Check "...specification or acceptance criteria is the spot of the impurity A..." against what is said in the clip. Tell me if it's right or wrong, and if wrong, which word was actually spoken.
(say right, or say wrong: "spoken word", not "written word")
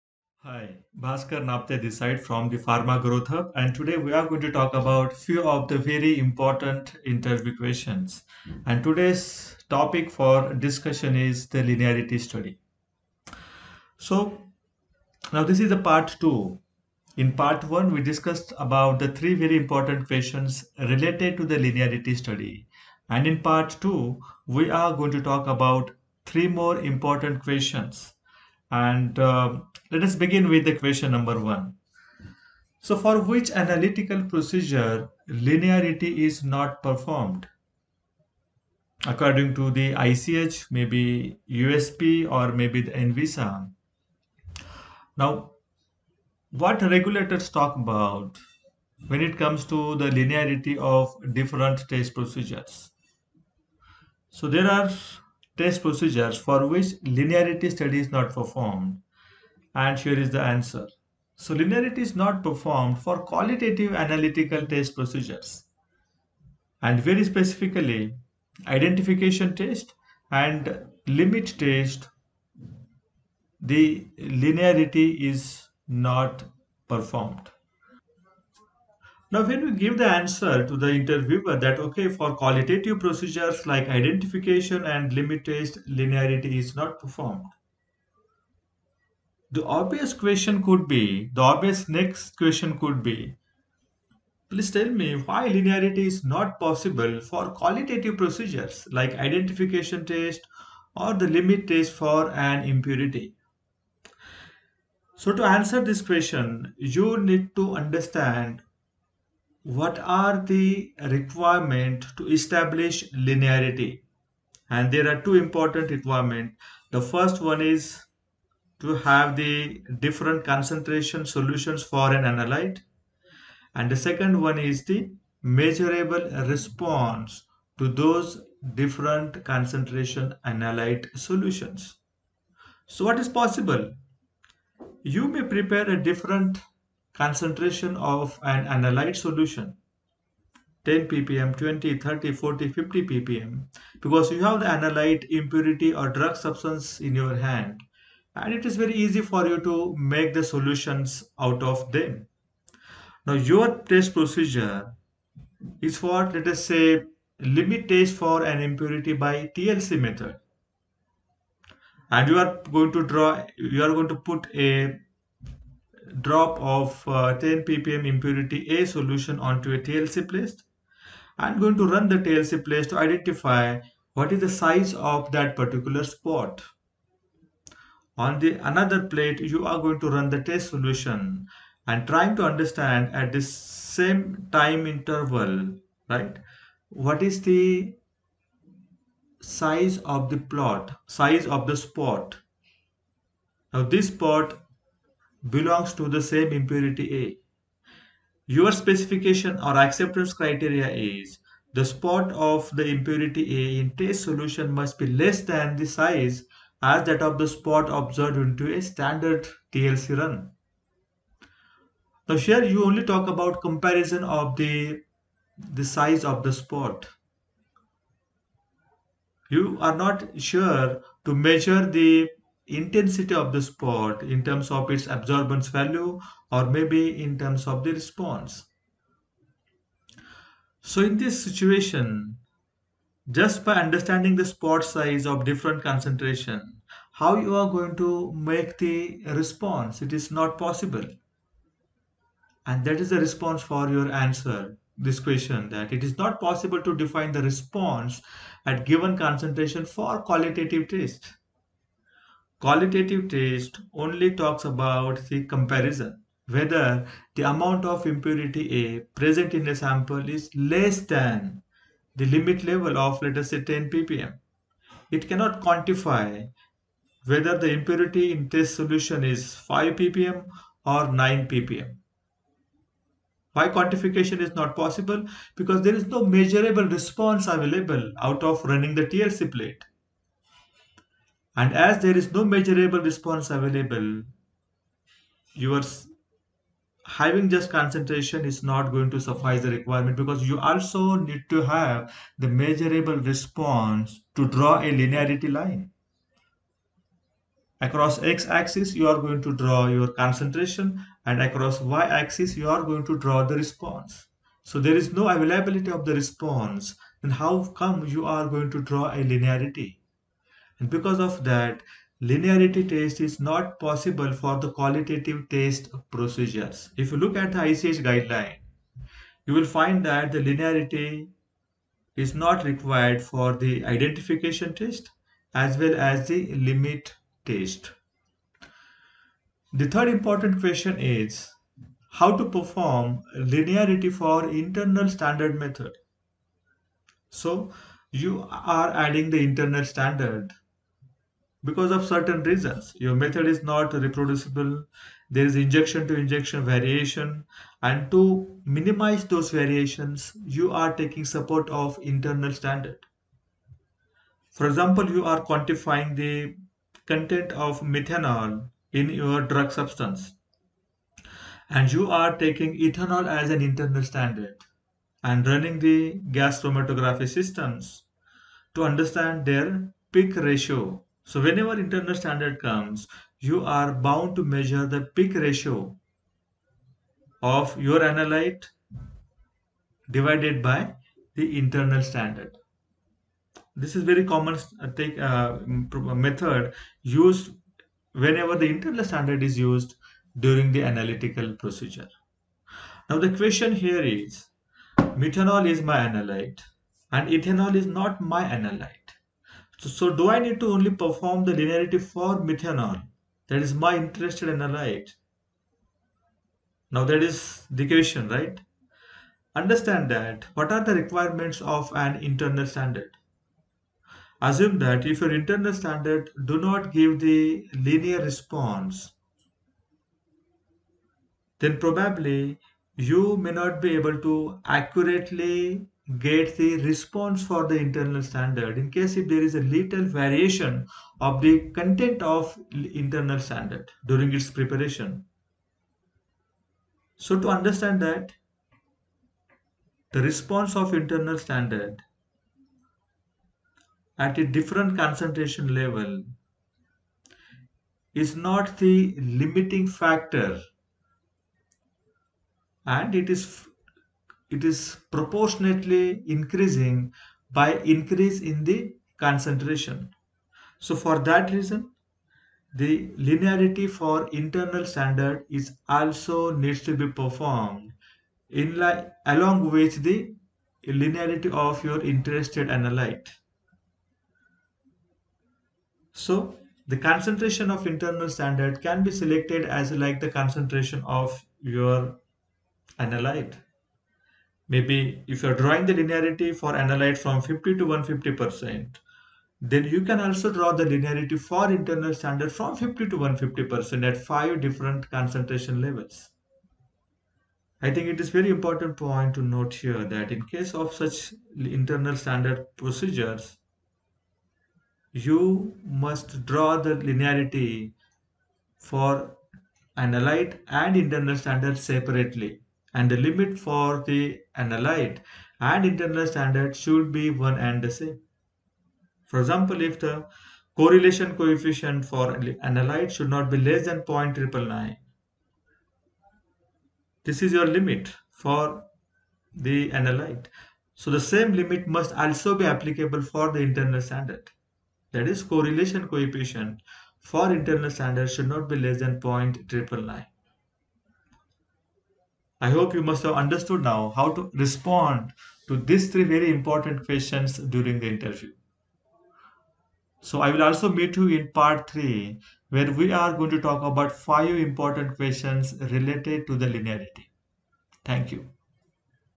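right.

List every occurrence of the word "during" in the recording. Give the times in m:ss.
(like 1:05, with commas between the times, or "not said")
6:30, 7:14, 9:07.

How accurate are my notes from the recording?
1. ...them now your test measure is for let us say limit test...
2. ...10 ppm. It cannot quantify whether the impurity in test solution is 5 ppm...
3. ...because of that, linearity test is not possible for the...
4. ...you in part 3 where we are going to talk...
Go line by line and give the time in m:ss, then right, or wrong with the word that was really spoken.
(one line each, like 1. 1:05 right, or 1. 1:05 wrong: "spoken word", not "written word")
1. 2:31 wrong: "procedure", not "measure"
2. 4:23 right
3. 5:10 right
4. 9:11 right.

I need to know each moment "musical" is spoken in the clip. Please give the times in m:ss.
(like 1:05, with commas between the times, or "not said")
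not said.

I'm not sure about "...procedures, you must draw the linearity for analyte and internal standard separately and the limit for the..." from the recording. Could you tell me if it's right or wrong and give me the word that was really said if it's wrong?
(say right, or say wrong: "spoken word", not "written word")
right.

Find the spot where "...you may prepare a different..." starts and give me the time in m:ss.
2:15.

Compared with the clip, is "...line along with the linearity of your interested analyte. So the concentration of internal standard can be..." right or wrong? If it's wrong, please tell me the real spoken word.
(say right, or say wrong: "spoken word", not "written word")
right.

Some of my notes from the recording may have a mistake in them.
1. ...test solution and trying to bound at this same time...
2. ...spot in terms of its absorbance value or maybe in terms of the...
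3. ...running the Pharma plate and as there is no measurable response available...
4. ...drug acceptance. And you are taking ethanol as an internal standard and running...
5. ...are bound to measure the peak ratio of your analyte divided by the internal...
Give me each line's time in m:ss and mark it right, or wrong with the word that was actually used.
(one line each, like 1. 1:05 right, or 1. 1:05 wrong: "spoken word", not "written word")
1. 3:00 wrong: "understand", not "bound"
2. 3:43 right
3. 4:38 wrong: "TLC", not "Pharma"
4. 5:59 wrong: "substance", not "acceptance"
5. 6:13 right.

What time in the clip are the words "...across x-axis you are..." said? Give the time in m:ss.
4:57.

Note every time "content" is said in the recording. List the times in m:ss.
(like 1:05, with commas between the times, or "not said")
5:57, 7:11.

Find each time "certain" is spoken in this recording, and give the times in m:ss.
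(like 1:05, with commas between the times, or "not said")
5:42.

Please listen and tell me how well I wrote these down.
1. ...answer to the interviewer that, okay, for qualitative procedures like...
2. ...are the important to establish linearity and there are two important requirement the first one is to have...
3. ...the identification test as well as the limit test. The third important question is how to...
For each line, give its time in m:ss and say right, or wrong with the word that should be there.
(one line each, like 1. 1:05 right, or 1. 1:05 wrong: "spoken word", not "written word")
1. 1:20 right
2. 1:49 wrong: "requirement", not "important"
3. 5:23 right.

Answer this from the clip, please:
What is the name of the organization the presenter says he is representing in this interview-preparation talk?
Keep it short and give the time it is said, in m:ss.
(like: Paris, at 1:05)
Pharma Growth Hub, at 0:02.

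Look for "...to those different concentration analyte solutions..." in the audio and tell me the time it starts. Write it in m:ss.
2:07.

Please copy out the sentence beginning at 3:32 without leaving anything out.
Now here you only talk about comparison of the, the size of the spot.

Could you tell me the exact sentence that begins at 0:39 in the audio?
According to the ICH, maybe USP or maybe the ANVISA.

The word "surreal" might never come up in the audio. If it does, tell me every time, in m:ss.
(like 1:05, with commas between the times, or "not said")
not said.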